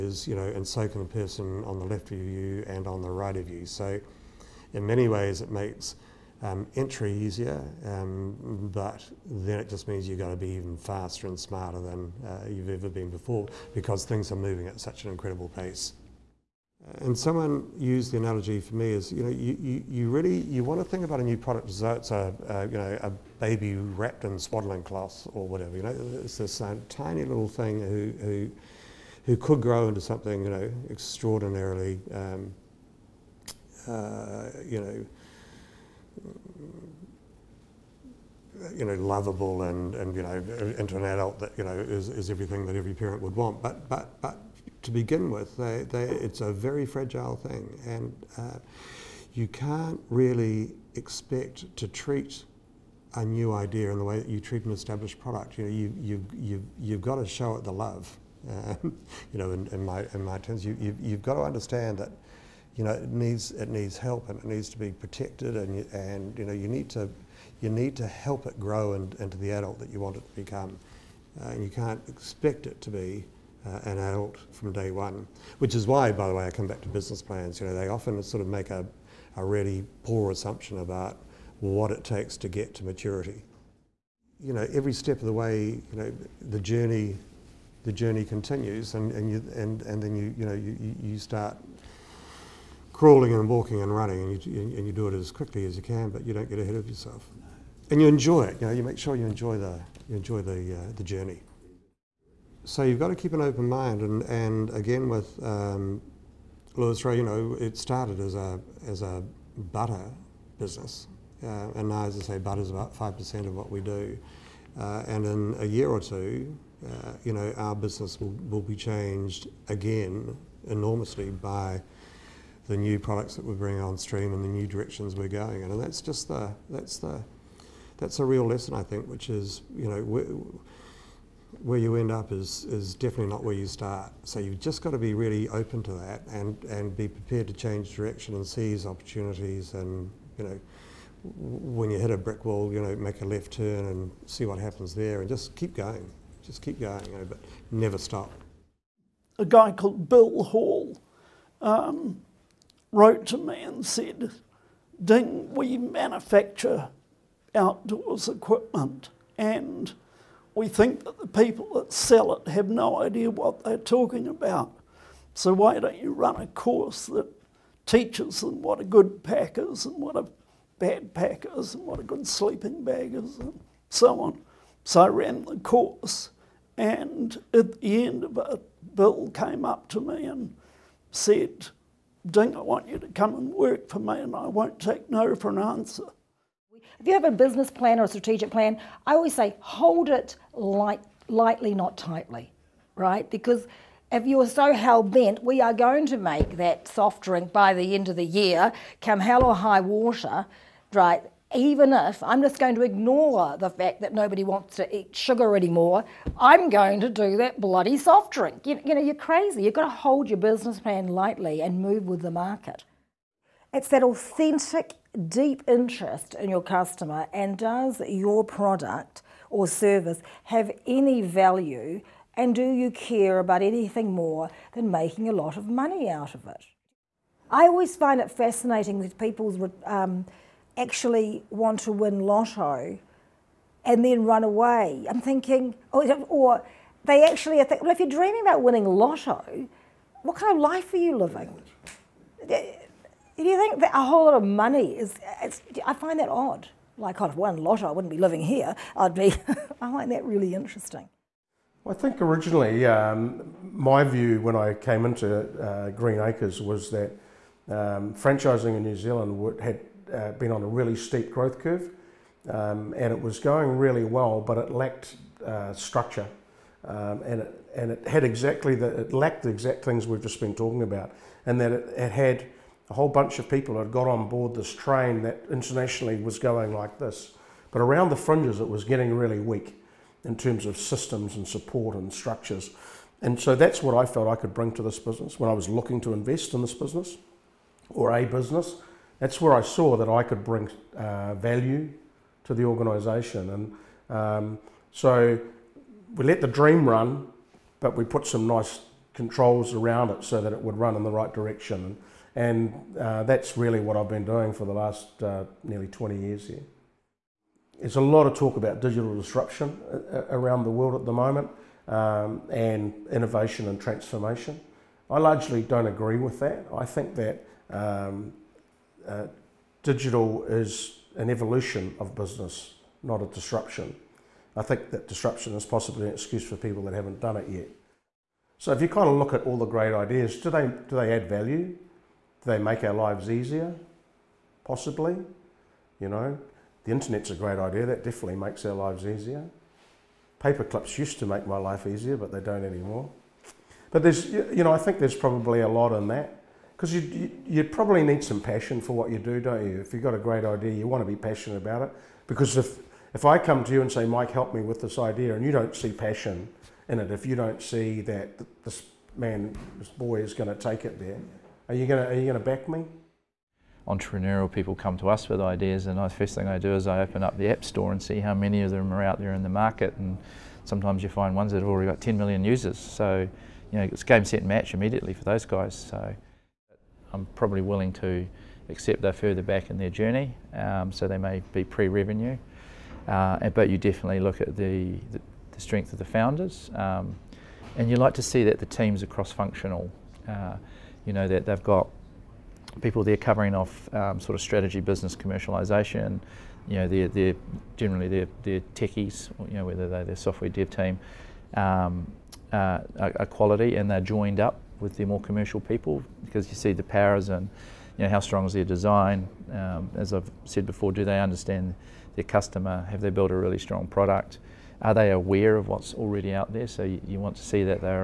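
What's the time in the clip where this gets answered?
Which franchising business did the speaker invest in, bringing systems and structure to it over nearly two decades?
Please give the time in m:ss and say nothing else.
4:15.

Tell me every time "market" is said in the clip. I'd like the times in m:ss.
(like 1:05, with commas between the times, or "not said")
3:32, 6:09.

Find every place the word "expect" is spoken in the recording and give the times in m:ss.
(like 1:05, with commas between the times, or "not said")
0:50, 1:12.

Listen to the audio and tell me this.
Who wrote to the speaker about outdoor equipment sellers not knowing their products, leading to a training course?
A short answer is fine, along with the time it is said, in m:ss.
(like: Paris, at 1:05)
Bill Hall, at 2:30.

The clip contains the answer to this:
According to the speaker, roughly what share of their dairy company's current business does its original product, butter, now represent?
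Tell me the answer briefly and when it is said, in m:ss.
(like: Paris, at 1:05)
5 percent, at 1:52.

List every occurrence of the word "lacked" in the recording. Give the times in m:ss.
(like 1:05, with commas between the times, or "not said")
4:24, 4:29.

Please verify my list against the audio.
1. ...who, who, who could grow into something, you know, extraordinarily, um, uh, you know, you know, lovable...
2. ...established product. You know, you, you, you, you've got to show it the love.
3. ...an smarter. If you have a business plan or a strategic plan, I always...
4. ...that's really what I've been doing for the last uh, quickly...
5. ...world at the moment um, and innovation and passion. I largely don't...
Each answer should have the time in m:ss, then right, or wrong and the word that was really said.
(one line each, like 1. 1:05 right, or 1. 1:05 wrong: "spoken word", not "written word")
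1. 0:27 right
2. 0:54 right
3. 3:05 wrong: "answer", not "smarter"
4. 5:03 wrong: "nearly", not "quickly"
5. 5:10 wrong: "transformation", not "passion".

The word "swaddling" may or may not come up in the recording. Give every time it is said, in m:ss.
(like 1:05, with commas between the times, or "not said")
0:24.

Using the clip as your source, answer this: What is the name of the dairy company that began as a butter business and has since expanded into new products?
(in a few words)
Lewis Road.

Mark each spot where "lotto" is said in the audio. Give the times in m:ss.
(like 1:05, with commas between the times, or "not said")
3:52, 3:58, 4:07.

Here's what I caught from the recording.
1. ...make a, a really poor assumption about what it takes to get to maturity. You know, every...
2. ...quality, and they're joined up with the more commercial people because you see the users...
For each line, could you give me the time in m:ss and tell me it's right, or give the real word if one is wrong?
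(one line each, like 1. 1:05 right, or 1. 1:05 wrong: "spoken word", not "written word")
1. 1:18 right
2. 6:43 wrong: "powers", not "users".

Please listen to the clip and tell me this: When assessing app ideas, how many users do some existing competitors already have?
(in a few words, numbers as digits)
10 million.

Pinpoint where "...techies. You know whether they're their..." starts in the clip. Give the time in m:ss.
6:38.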